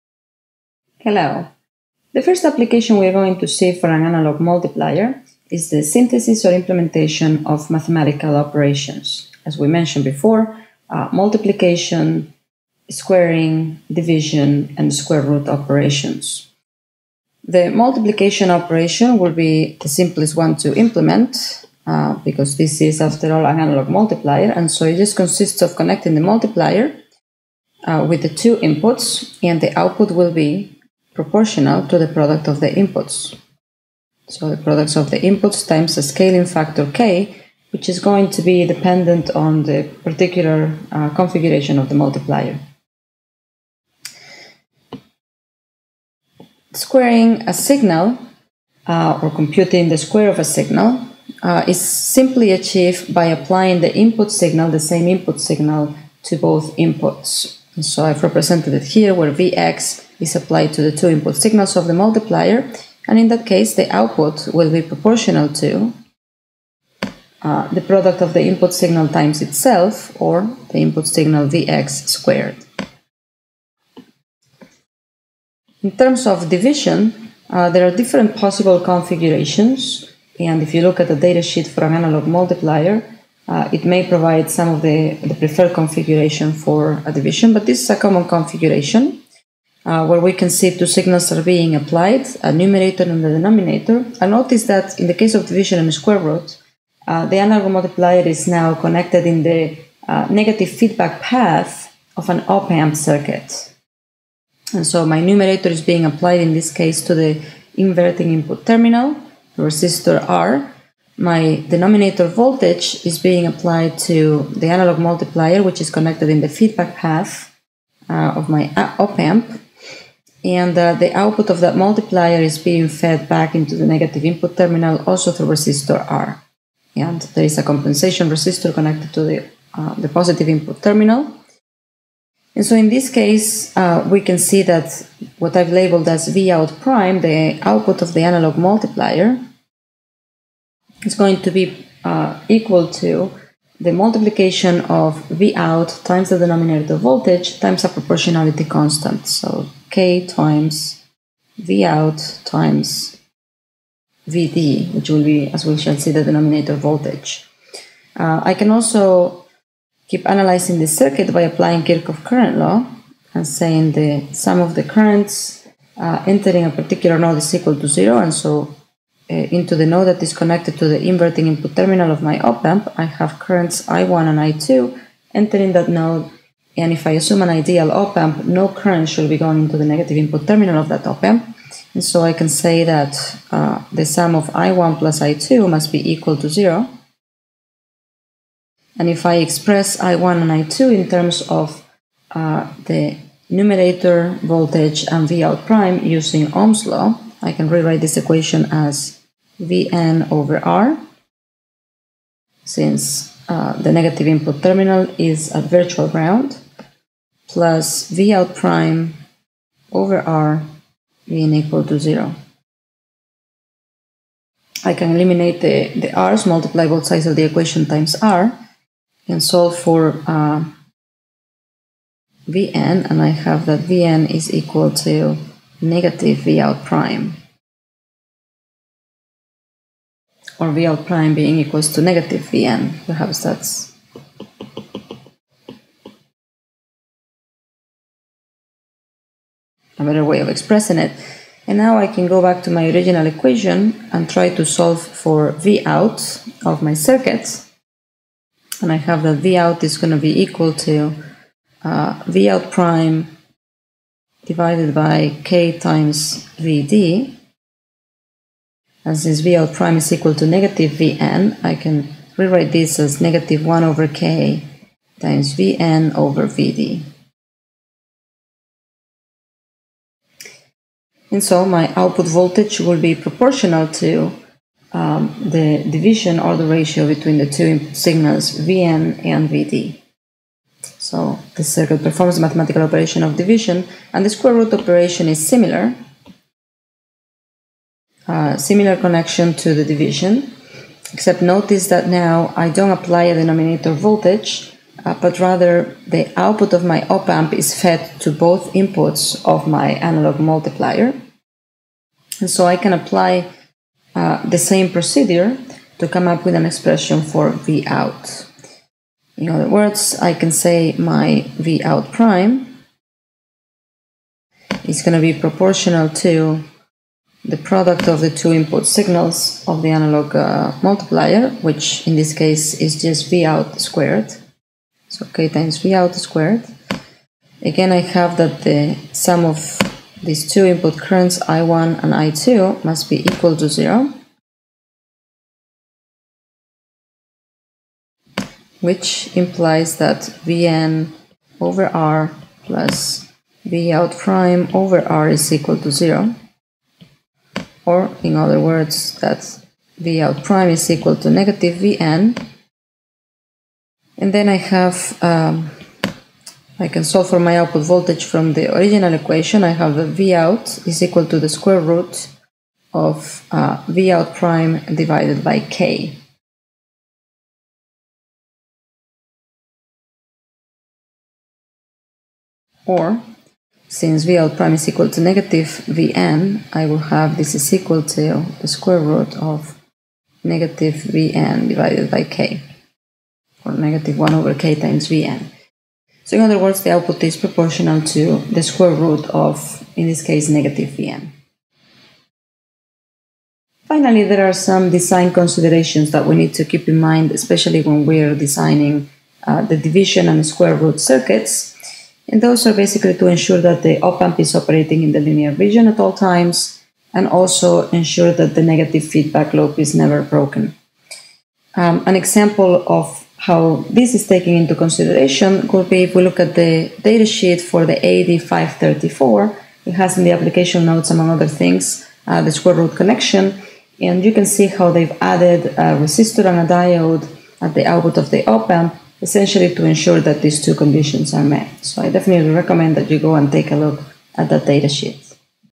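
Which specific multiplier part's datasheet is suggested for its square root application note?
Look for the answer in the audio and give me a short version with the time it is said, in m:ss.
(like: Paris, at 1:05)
AD534, at 6:57.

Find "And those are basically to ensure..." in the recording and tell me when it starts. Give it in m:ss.
6:42.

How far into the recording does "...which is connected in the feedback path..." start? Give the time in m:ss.
1:55.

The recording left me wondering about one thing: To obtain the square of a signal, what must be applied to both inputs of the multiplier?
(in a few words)
The same input signal.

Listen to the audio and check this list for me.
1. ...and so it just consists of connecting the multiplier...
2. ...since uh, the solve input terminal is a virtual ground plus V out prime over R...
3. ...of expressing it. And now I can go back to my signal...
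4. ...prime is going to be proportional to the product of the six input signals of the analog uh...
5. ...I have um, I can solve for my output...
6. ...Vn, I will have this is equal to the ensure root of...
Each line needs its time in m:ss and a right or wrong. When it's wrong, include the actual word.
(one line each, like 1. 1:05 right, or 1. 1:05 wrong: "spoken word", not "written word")
1. 0:24 right
2. 3:22 wrong: "negative", not "solve"
3. 4:00 wrong: "original", not "signal"
4. 5:12 wrong: "two", not "six"
5. 5:54 right
6. 6:15 wrong: "square", not "ensure".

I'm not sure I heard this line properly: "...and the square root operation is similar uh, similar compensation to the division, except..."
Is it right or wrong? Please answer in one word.
wrong.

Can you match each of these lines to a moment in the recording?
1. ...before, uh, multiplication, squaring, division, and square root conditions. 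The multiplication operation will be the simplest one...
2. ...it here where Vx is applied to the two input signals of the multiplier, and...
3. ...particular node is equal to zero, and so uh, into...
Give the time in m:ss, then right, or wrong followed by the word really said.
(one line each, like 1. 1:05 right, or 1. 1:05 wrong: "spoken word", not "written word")
1. 0:10 wrong: "operations", not "conditions"
2. 0:58 right
3. 2:46 right.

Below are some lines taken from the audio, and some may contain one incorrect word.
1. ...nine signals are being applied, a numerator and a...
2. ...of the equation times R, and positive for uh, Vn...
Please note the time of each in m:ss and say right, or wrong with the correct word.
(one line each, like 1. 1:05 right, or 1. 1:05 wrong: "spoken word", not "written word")
1. 1:30 wrong: "two", not "nine"
2. 3:37 wrong: "solve", not "positive".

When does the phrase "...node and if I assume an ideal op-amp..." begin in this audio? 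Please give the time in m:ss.
2:55.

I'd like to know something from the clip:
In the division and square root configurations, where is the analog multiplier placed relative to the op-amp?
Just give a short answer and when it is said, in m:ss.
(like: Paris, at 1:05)
Negative feedback path, at 1:40.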